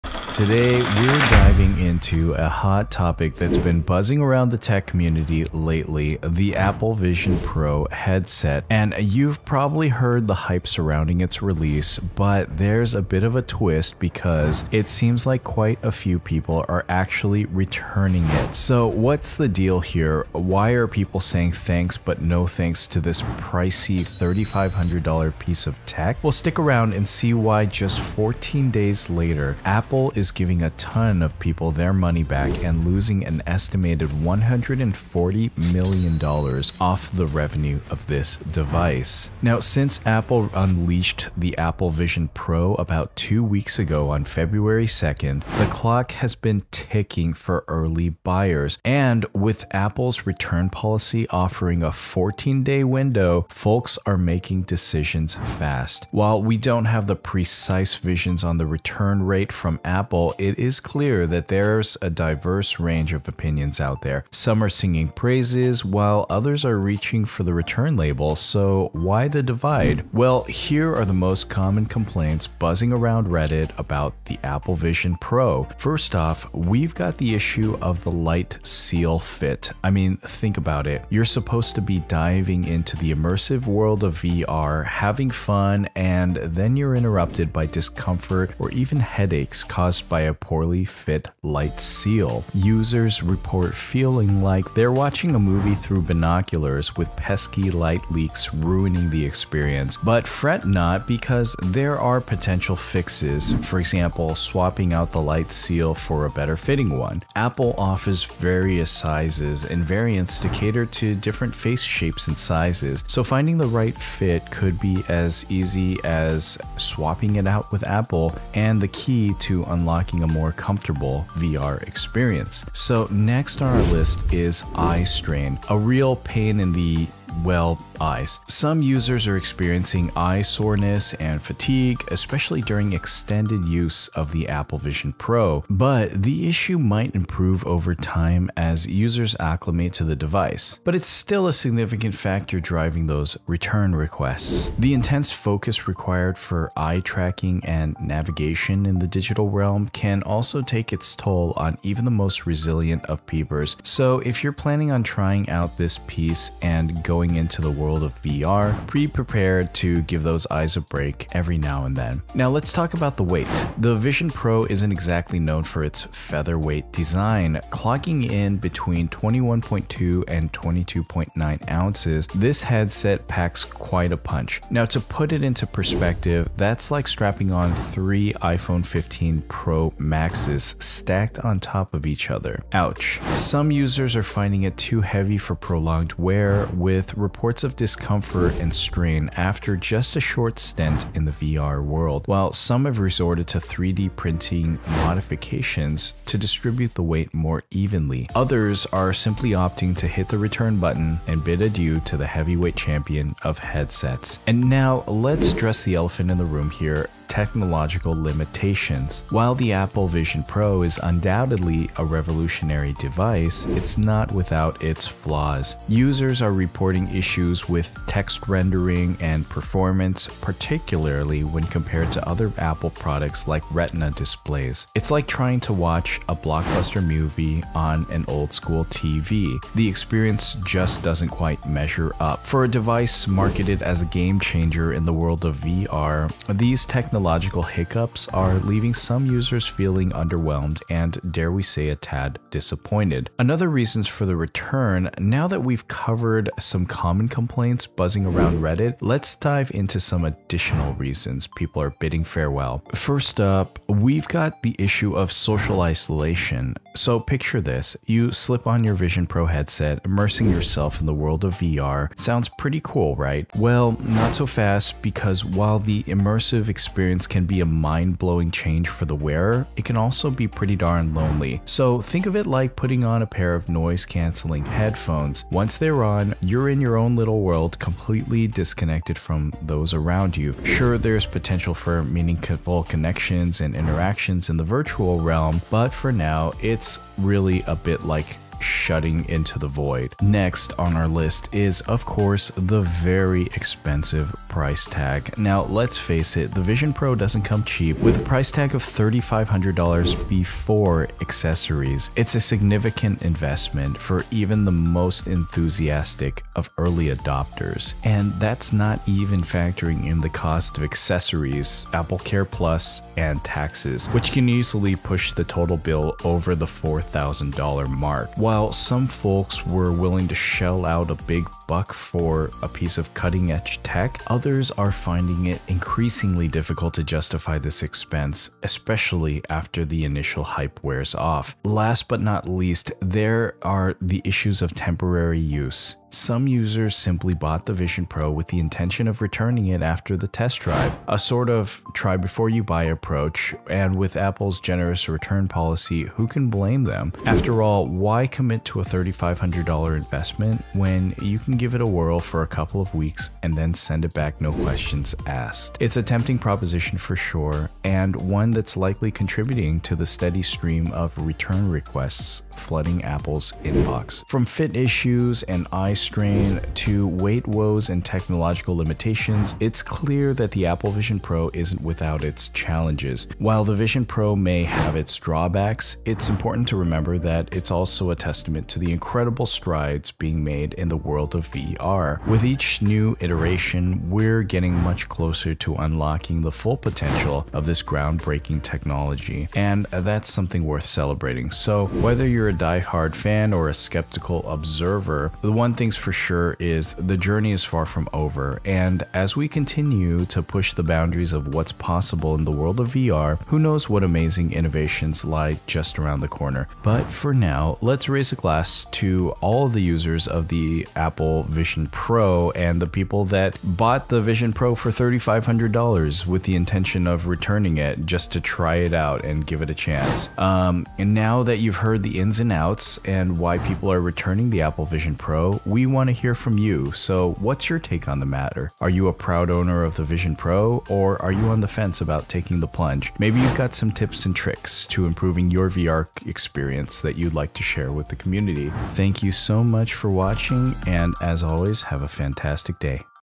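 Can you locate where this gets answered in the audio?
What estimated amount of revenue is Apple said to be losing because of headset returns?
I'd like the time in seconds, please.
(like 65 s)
34 s.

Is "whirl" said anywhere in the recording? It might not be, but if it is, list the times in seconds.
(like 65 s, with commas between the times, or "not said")
351 s.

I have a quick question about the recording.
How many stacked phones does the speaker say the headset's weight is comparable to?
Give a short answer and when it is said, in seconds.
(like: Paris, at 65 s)
3, at 177 s.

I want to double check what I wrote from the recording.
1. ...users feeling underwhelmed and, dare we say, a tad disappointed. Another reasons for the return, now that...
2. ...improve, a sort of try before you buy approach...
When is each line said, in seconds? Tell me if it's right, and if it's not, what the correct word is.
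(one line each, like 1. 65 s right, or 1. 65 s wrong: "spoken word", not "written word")
1. 239 s right
2. 340 s wrong: "drive", not "improve".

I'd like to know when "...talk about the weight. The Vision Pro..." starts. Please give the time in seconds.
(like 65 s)
162 s.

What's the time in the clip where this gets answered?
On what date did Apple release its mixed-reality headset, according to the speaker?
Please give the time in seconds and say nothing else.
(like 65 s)
44 s.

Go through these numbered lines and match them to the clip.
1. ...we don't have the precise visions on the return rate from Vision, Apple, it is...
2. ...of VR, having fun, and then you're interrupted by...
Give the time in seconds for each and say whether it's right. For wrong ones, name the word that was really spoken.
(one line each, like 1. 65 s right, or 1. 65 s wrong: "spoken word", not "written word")
1. 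56 s wrong: "Apple", not "Vision"
2. 84 s right.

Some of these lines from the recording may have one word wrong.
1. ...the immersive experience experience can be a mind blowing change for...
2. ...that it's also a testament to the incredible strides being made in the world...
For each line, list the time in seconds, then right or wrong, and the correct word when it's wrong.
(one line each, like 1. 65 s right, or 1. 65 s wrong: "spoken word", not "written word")
1. 265 s right
2. 377 s right.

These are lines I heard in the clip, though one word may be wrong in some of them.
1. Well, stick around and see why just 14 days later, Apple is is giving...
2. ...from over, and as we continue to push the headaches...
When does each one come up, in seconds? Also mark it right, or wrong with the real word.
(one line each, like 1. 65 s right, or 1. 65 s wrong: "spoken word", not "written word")
1. 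26 s right
2. 397 s wrong: "boundaries", not "headaches".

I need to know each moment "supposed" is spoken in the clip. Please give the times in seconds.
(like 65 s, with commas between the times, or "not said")
81 s.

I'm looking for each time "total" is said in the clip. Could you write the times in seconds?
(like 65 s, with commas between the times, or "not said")
315 s.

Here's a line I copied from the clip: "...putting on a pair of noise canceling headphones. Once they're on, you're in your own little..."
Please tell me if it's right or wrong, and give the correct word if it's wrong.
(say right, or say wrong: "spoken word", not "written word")
right.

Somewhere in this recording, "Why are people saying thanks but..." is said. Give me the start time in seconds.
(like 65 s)
20 s.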